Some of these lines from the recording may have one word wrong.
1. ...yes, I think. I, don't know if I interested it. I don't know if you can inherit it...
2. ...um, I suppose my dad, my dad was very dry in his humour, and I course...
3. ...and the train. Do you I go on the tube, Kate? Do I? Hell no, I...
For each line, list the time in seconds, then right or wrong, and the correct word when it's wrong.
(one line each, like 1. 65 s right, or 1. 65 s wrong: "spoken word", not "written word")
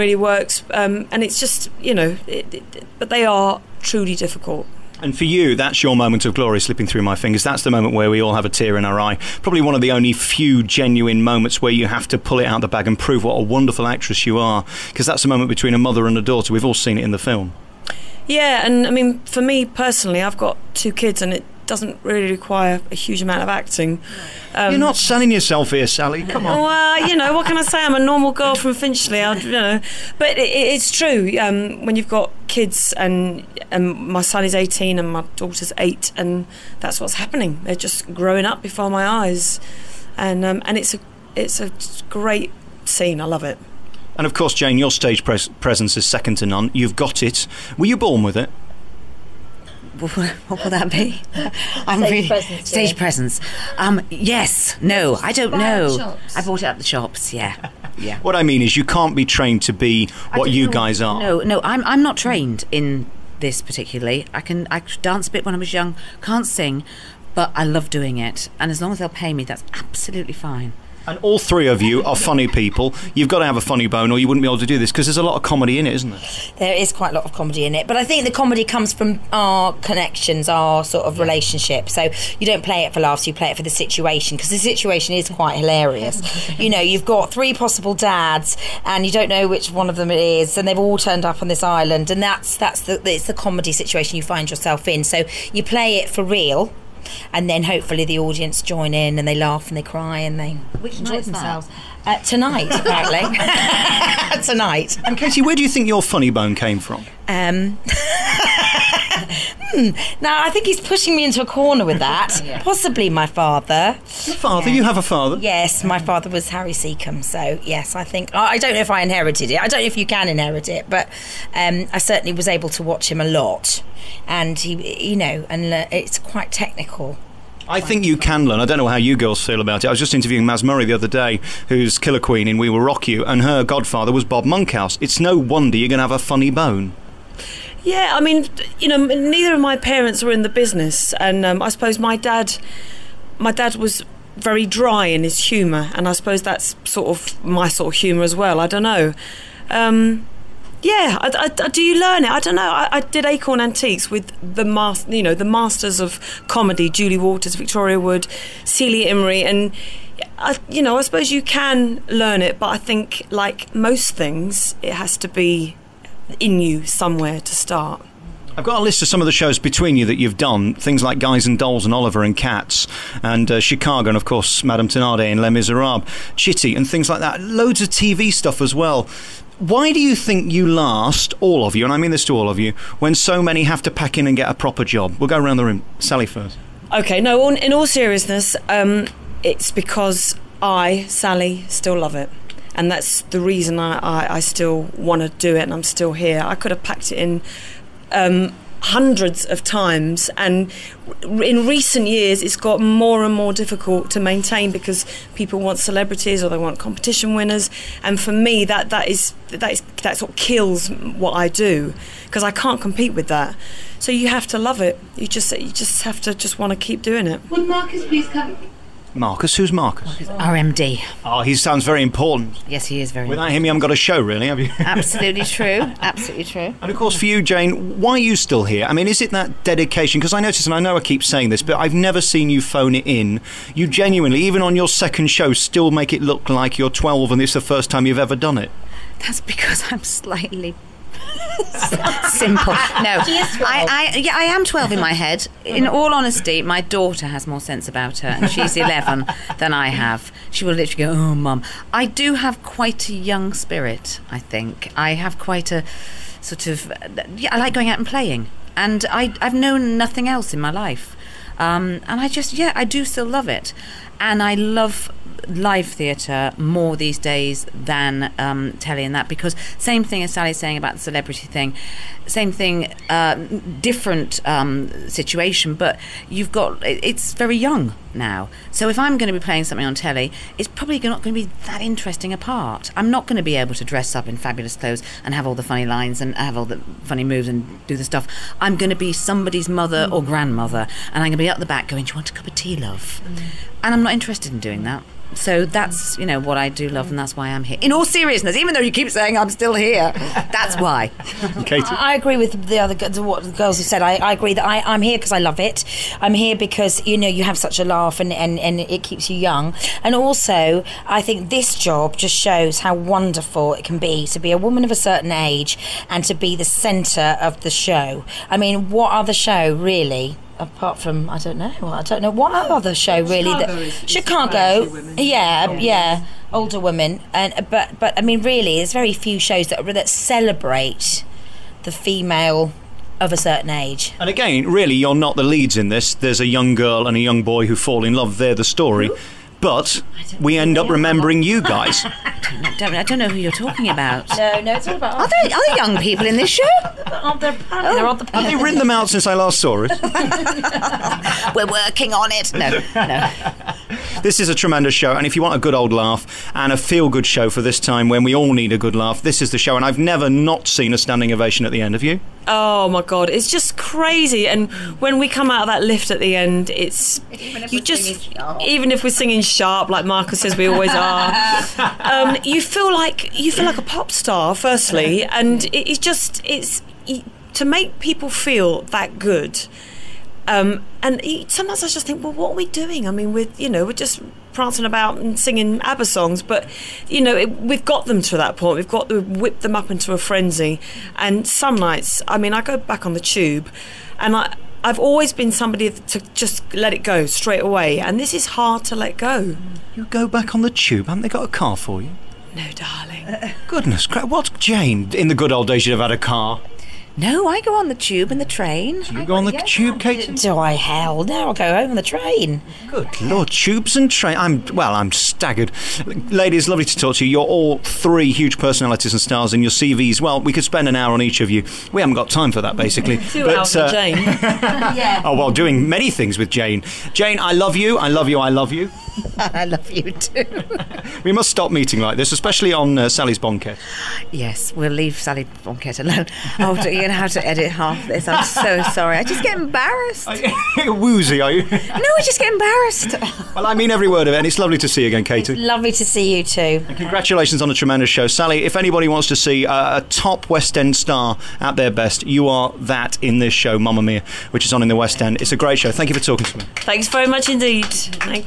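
1. 117 s wrong: "inherited", not "interested"
2. 141 s wrong: "suppose", not "course"
3. 408 s right.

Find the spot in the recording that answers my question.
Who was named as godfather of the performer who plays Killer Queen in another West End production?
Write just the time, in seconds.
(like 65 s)
134 s.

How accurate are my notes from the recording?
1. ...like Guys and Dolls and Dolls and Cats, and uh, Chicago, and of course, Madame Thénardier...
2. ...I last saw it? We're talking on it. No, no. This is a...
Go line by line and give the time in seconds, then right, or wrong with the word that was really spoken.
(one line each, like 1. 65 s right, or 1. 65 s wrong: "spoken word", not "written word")
1. 171 s wrong: "Oliver", not "Dolls"
2. 349 s wrong: "working", not "talking".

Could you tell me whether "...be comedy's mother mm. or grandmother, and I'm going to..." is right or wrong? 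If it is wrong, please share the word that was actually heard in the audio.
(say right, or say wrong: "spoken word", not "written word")
wrong: "somebody", not "comedy".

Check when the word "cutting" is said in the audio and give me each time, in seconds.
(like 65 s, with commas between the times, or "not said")
not said.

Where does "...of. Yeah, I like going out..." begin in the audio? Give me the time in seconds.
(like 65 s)
256 s.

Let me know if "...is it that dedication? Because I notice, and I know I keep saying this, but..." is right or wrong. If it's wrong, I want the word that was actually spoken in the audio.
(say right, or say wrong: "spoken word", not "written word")
right.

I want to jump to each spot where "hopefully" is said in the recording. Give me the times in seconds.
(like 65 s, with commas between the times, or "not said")
97 s.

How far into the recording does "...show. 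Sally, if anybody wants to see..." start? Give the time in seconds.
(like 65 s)
448 s.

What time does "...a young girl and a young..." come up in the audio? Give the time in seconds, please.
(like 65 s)
336 s.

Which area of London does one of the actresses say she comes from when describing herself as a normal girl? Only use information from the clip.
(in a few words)
Finchley.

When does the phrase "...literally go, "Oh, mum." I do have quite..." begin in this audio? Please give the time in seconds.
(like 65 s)
250 s.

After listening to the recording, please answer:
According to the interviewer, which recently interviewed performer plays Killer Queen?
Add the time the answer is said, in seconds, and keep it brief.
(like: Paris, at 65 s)
Mazz Murray, at 130 s.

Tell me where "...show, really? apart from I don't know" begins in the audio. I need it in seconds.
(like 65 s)
319 s.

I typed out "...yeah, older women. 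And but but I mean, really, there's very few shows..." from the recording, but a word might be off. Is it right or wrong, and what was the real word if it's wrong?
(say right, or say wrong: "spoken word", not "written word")
right.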